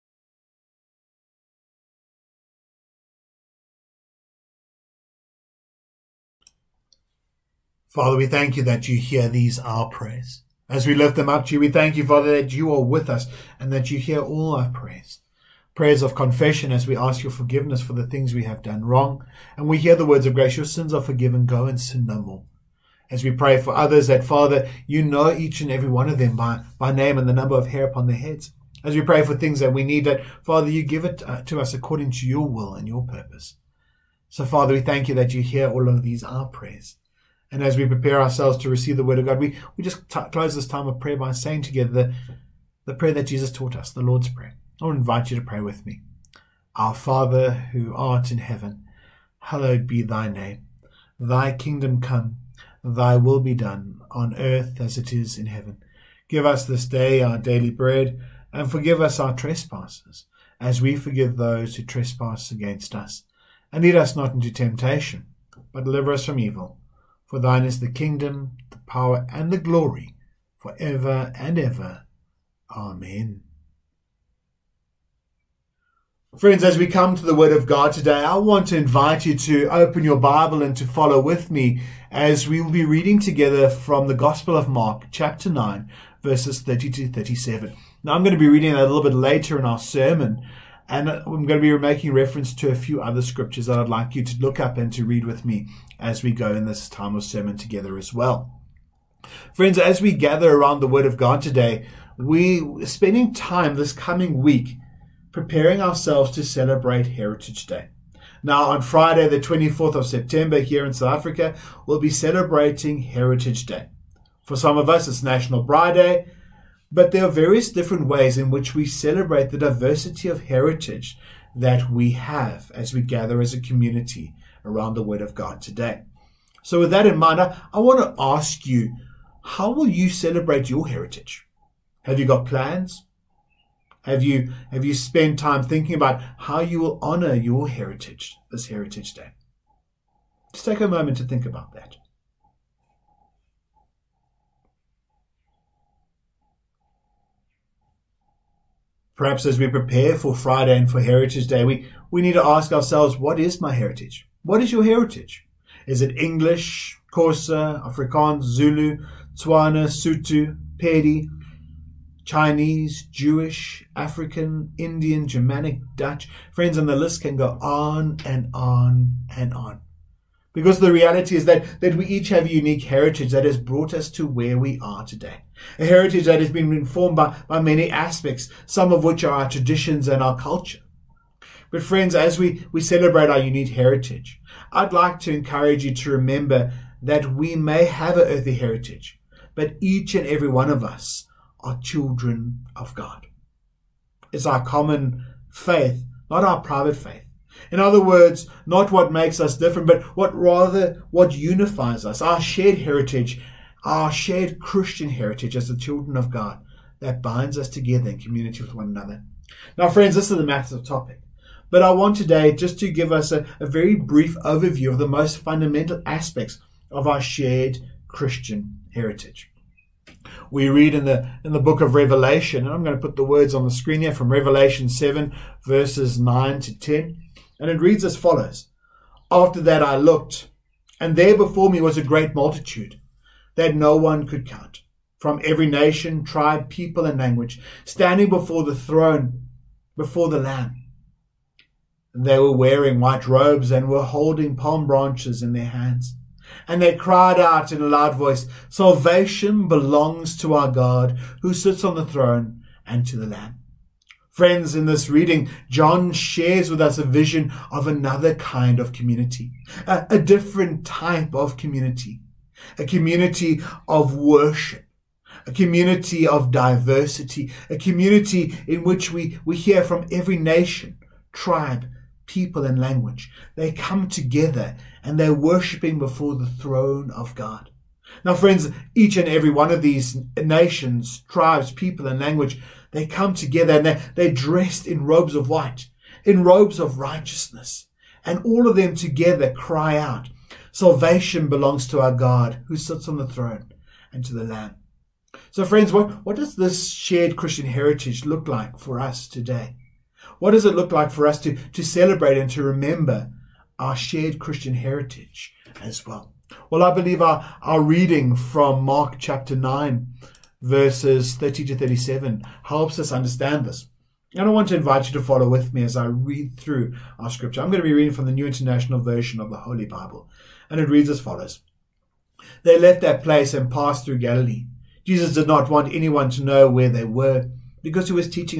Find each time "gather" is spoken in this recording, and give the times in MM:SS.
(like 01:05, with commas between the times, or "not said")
01:40, 02:03.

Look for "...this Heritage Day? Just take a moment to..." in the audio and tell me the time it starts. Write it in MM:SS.
02:18.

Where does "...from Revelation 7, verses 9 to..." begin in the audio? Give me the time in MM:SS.
03:44.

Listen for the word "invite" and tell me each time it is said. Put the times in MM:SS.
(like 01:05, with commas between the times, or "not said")
00:44, 01:18, 05:14.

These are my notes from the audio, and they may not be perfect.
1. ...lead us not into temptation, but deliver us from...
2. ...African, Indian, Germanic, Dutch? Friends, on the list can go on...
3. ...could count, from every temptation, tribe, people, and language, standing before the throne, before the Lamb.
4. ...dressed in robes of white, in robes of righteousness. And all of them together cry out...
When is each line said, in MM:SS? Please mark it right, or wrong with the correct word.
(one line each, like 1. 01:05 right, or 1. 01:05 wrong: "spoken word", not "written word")
1. 01:03 right
2. 02:43 right
3. 03:54 wrong: "nation", not "temptation"
4. 04:44 right.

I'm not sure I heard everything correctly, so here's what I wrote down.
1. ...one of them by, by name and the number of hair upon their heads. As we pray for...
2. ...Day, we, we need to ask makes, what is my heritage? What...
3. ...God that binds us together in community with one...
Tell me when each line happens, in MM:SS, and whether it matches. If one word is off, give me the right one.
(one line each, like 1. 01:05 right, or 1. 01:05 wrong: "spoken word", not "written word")
1. 00:25 right
2. 02:31 wrong: "ourselves", not "makes"
3. 03:26 right.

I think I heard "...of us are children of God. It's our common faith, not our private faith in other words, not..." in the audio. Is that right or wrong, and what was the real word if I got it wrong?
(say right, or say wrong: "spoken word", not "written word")
right.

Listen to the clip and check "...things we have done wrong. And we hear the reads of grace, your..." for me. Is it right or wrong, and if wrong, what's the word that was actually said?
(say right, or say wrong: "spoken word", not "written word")
wrong: "words", not "reads".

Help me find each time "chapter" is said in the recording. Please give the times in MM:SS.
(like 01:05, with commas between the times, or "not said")
01:25, 05:09.